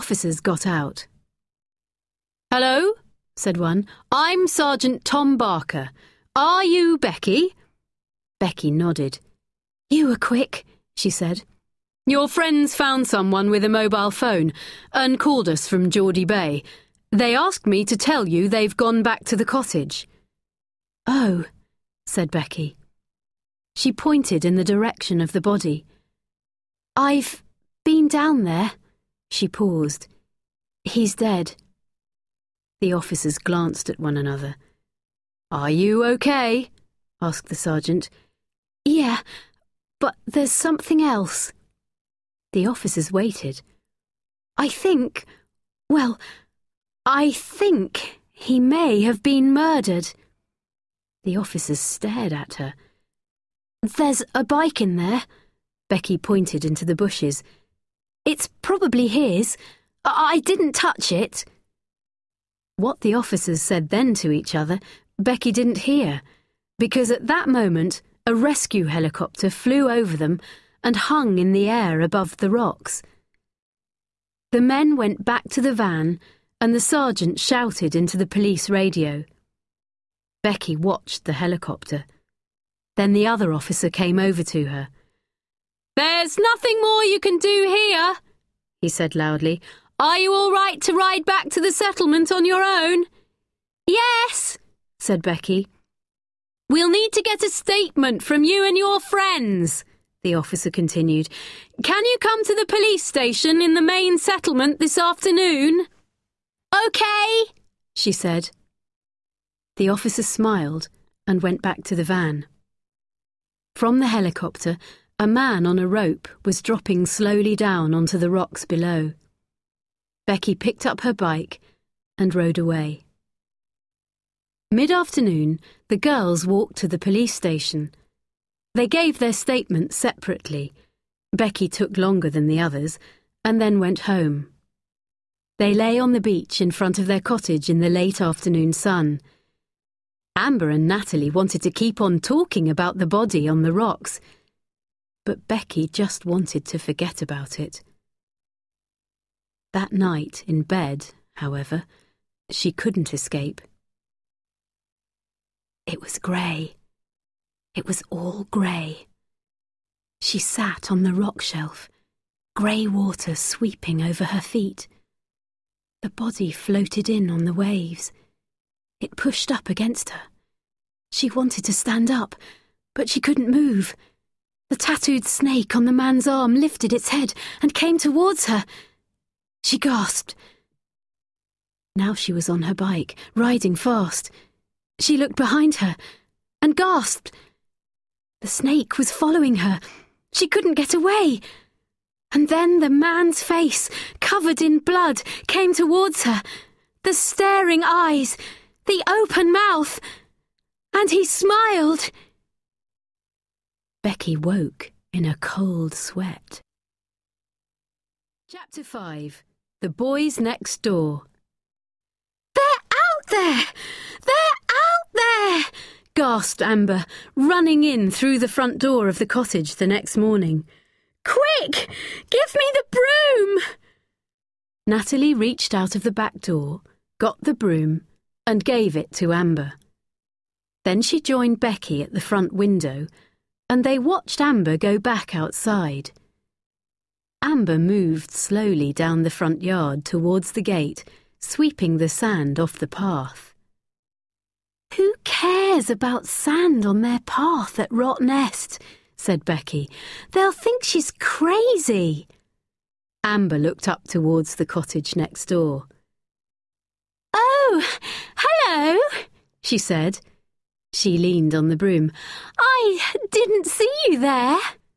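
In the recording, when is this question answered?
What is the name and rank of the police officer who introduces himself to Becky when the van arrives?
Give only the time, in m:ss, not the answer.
0:04.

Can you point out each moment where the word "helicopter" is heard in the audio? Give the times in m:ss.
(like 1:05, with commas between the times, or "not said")
1:08, 1:21, 1:54.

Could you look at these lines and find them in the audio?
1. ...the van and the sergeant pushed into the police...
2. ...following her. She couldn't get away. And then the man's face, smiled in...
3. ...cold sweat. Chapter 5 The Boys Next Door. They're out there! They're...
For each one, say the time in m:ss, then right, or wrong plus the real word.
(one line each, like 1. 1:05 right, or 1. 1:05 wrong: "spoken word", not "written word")
1. 1:15 wrong: "shouted", not "pushed"
2. 3:09 wrong: "covered", not "smiled"
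3. 3:25 right.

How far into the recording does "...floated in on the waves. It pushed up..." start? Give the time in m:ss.
2:46.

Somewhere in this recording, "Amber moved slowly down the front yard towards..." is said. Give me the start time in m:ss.
3:57.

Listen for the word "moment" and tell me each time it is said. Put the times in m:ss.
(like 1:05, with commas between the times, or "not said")
1:07.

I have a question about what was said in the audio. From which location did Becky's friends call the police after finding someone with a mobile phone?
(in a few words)
Geordie Bay.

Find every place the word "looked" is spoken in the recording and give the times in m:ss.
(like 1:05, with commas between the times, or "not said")
3:05, 4:13.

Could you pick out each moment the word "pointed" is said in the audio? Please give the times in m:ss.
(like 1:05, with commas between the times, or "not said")
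0:23, 0:56.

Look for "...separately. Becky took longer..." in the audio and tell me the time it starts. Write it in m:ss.
2:09.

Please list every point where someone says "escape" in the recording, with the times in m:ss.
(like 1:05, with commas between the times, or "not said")
2:33.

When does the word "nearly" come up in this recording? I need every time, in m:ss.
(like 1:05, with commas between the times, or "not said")
not said.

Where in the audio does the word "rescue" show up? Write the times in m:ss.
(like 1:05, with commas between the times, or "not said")
1:08.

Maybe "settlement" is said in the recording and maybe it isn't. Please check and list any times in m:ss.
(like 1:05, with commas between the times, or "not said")
1:31, 1:44.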